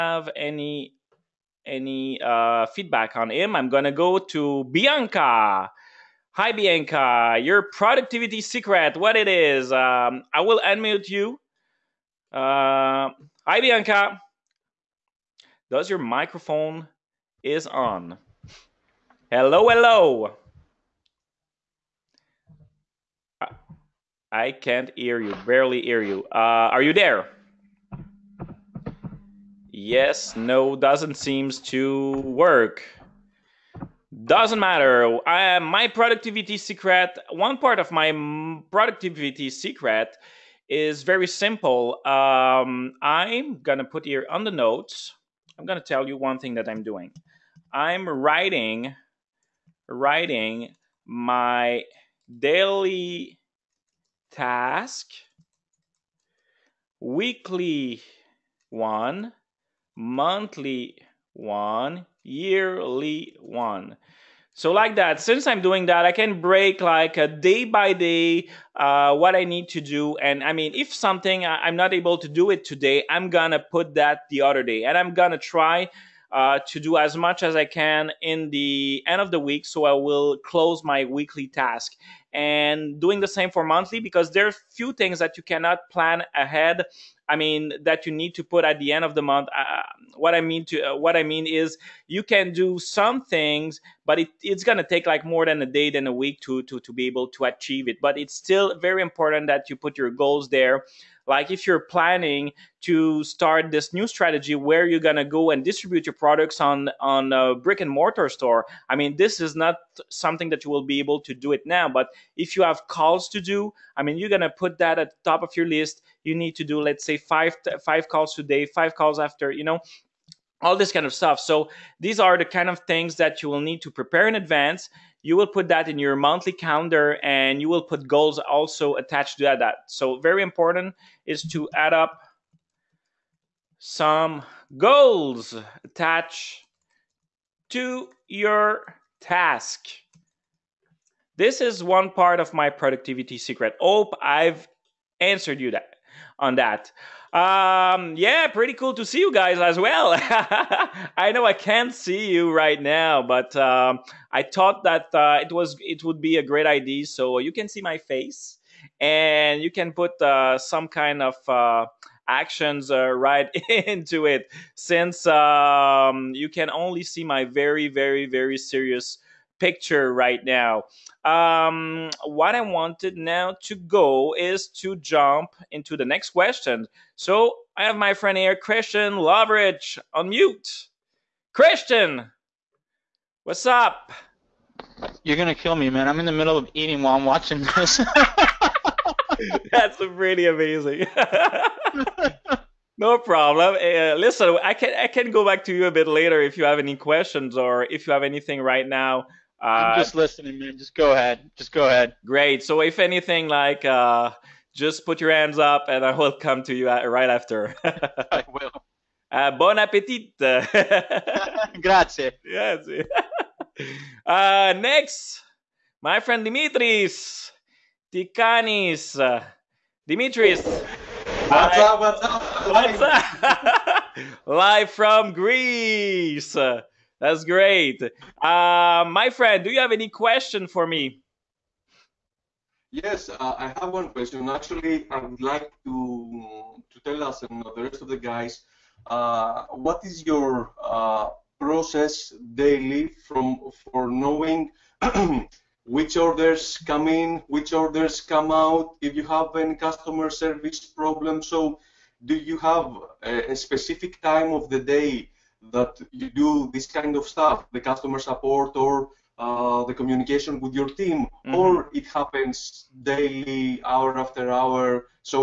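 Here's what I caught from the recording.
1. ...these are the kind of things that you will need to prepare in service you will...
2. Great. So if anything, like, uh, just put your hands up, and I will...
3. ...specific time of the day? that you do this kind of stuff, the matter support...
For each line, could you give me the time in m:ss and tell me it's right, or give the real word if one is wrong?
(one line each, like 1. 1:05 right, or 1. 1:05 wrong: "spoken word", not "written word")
1. 2:01 wrong: "advance", not "service"
2. 3:22 right
3. 4:13 wrong: "customer", not "matter".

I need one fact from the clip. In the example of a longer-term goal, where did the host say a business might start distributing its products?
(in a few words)
Brick and mortar store.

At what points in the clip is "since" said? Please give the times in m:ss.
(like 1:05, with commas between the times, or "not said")
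1:05, 2:44.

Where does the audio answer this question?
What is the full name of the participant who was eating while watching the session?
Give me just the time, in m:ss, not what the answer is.
2:58.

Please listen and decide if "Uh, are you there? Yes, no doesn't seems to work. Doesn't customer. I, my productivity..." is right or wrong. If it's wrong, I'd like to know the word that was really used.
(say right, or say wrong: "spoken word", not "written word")
wrong: "matter", not "customer".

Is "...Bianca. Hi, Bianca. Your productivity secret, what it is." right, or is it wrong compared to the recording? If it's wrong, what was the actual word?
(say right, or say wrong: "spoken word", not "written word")
right.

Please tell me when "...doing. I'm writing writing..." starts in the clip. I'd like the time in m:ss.
0:46.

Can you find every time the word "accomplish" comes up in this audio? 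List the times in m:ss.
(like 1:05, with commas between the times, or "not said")
not said.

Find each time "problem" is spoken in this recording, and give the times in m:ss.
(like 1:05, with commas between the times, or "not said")
3:13, 4:11.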